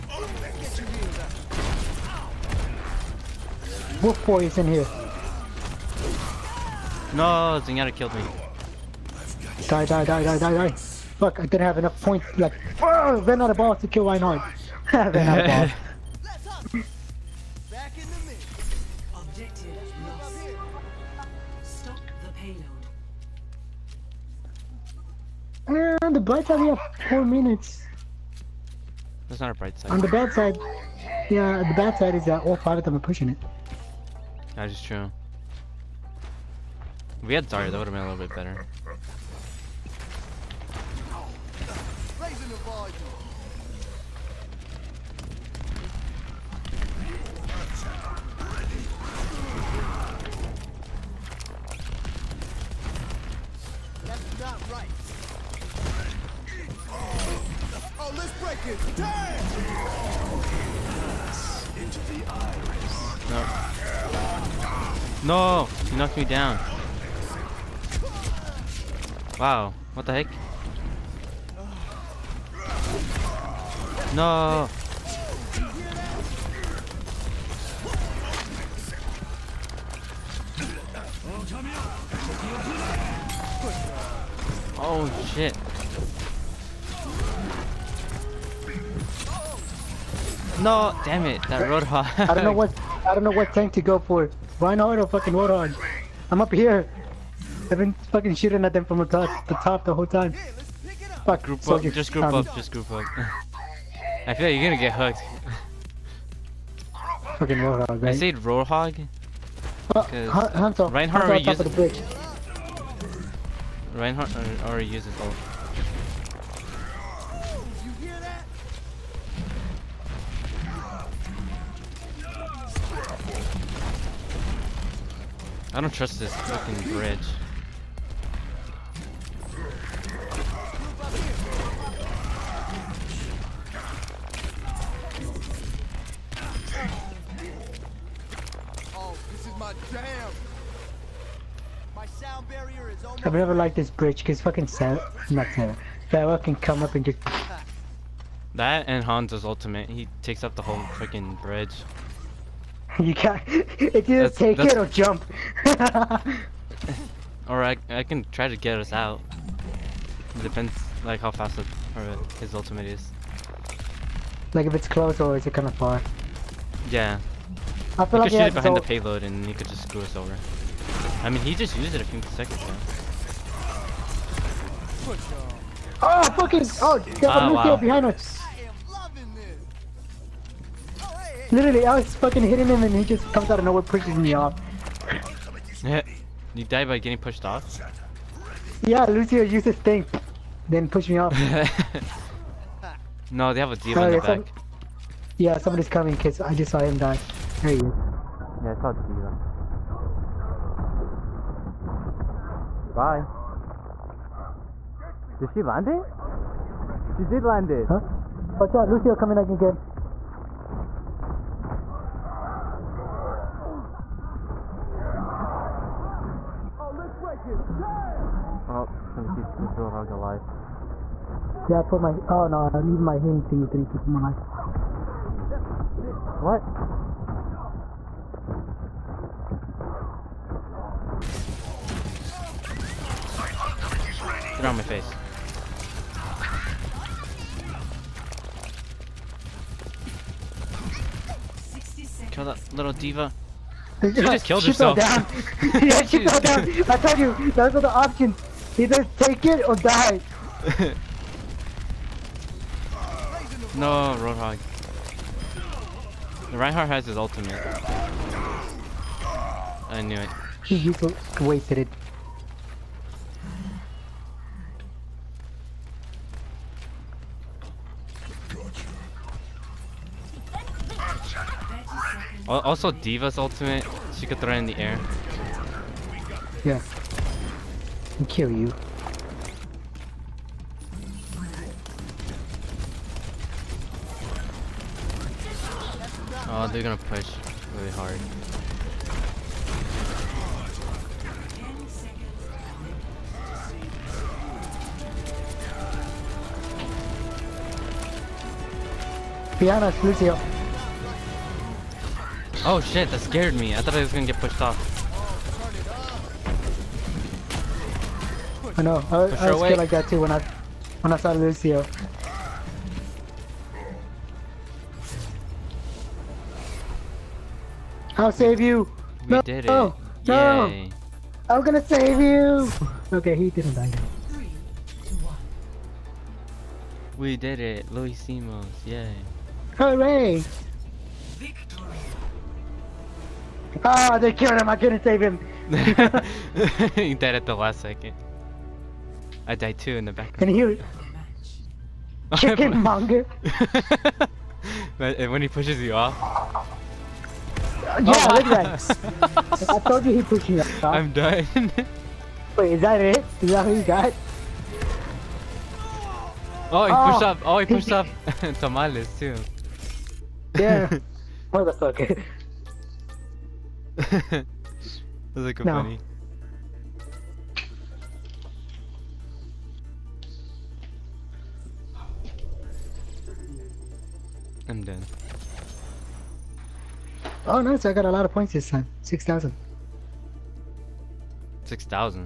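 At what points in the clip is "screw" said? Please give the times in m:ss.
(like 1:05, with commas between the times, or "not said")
2:49.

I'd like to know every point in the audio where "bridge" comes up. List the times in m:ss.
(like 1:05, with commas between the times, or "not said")
2:06, 2:23, 2:31.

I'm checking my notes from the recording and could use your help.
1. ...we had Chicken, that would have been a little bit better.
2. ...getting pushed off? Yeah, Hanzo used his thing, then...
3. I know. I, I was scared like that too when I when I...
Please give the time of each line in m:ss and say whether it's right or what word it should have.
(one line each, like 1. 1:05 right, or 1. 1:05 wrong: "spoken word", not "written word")
1. 0:37 wrong: "Zarya", not "Chicken"
2. 3:06 wrong: "Lucio", not "Hanzo"
3. 5:08 right.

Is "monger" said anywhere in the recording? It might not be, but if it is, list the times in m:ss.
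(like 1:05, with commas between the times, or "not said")
5:42.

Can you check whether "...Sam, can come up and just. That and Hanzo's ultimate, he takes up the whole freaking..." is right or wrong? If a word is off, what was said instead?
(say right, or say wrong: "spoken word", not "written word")
right.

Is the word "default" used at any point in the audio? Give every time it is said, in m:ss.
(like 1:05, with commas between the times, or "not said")
not said.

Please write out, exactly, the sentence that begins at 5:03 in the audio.
I thought I was gonna get pushed off.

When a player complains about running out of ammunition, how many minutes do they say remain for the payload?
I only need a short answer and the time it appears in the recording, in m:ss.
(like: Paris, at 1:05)
4, at 0:27.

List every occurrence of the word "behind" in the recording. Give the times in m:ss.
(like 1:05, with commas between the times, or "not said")
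2:48, 2:57.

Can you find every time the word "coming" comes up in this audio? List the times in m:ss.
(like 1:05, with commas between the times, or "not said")
3:15, 3:29.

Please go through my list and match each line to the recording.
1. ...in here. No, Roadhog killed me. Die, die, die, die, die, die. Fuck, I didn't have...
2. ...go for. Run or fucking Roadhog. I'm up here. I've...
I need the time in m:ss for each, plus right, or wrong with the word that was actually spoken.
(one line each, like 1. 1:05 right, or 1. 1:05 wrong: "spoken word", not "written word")
1. 0:04 wrong: "Zenyatta", not "Roadhog"
2. 1:33 right.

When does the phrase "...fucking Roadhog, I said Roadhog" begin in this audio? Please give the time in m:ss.
1:47.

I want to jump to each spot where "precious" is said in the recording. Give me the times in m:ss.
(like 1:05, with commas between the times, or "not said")
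not said.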